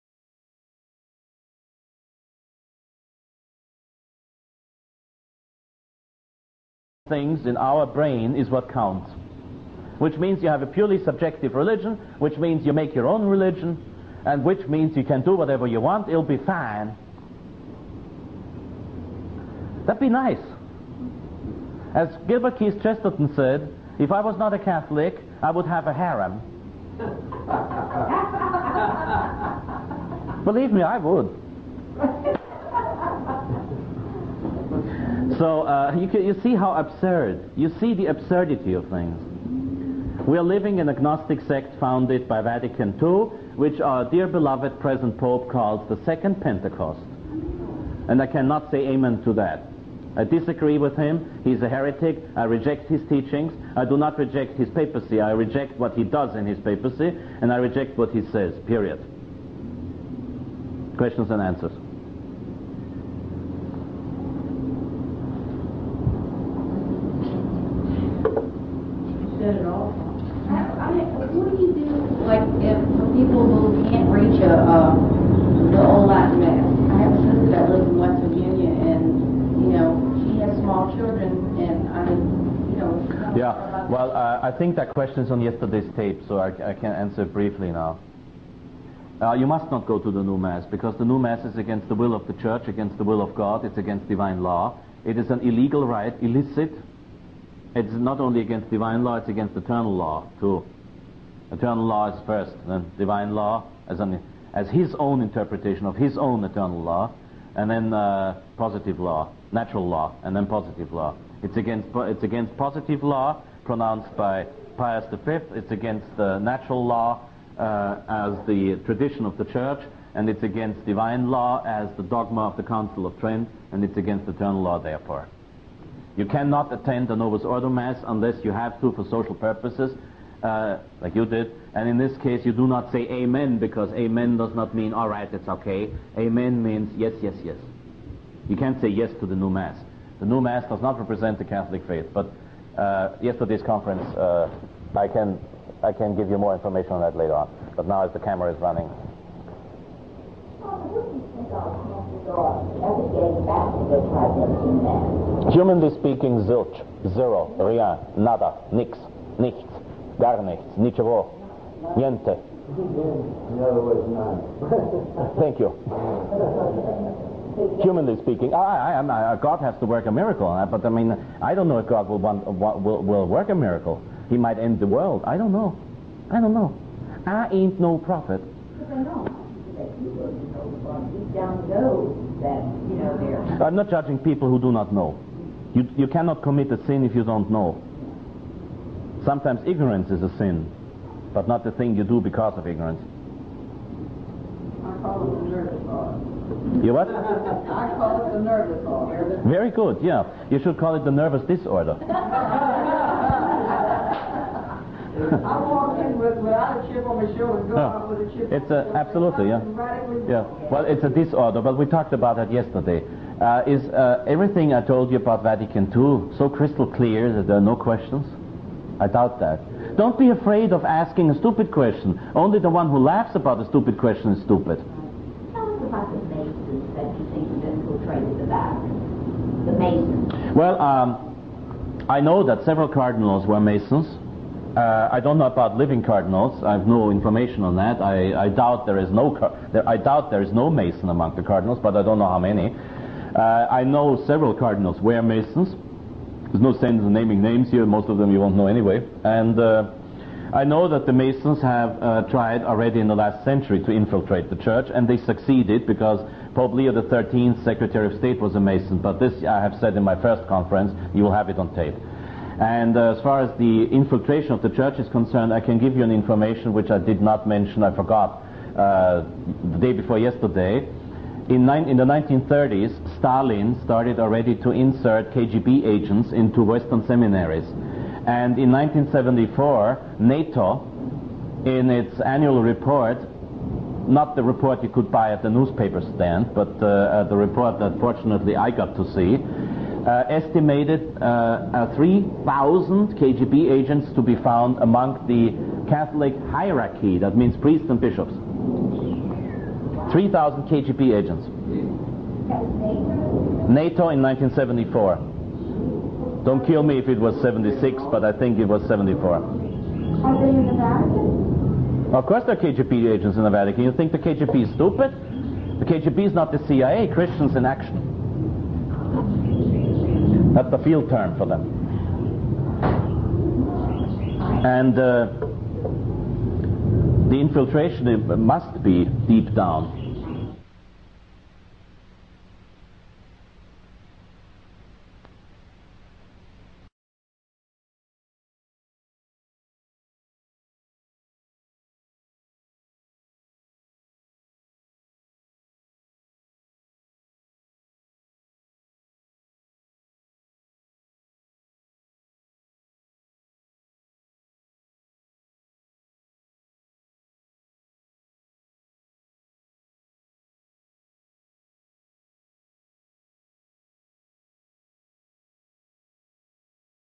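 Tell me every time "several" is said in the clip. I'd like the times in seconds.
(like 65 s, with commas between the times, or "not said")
232 s, 244 s.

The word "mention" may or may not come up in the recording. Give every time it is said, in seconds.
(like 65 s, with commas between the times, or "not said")
267 s.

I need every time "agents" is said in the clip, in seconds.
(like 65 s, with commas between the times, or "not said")
275 s, 293 s, 301 s, 313 s.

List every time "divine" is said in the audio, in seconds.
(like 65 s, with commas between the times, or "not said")
94 s, 98 s, 102 s, 120 s.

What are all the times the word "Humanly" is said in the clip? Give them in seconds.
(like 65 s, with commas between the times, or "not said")
155 s, 167 s.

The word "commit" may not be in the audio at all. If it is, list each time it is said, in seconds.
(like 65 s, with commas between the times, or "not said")
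186 s.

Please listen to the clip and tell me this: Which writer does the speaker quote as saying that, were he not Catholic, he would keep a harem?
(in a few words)
Gilbert Keith Chesterton.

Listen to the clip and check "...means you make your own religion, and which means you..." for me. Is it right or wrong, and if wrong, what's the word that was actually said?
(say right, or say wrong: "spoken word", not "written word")
right.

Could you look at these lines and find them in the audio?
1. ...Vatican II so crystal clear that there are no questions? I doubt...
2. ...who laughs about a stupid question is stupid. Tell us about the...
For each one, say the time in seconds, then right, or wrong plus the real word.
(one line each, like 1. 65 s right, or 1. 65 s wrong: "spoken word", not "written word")
1. 215 s right
2. 222 s right.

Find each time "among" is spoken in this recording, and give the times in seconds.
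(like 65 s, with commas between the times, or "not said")
241 s, 294 s.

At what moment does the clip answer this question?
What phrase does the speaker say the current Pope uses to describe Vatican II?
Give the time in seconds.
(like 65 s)
46 s.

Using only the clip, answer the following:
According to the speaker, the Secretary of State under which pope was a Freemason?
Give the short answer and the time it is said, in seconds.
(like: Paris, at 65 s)
Leo XIII, at 256 s.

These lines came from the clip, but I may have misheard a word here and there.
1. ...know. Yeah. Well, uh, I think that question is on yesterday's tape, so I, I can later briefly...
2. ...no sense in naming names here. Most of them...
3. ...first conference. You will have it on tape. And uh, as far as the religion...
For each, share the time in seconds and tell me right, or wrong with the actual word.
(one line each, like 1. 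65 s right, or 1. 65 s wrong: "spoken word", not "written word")
1. 82 s wrong: "answer", not "later"
2. 246 s right
3. 260 s wrong: "infiltration", not "religion".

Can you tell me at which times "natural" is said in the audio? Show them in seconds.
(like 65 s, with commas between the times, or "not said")
109 s, 116 s.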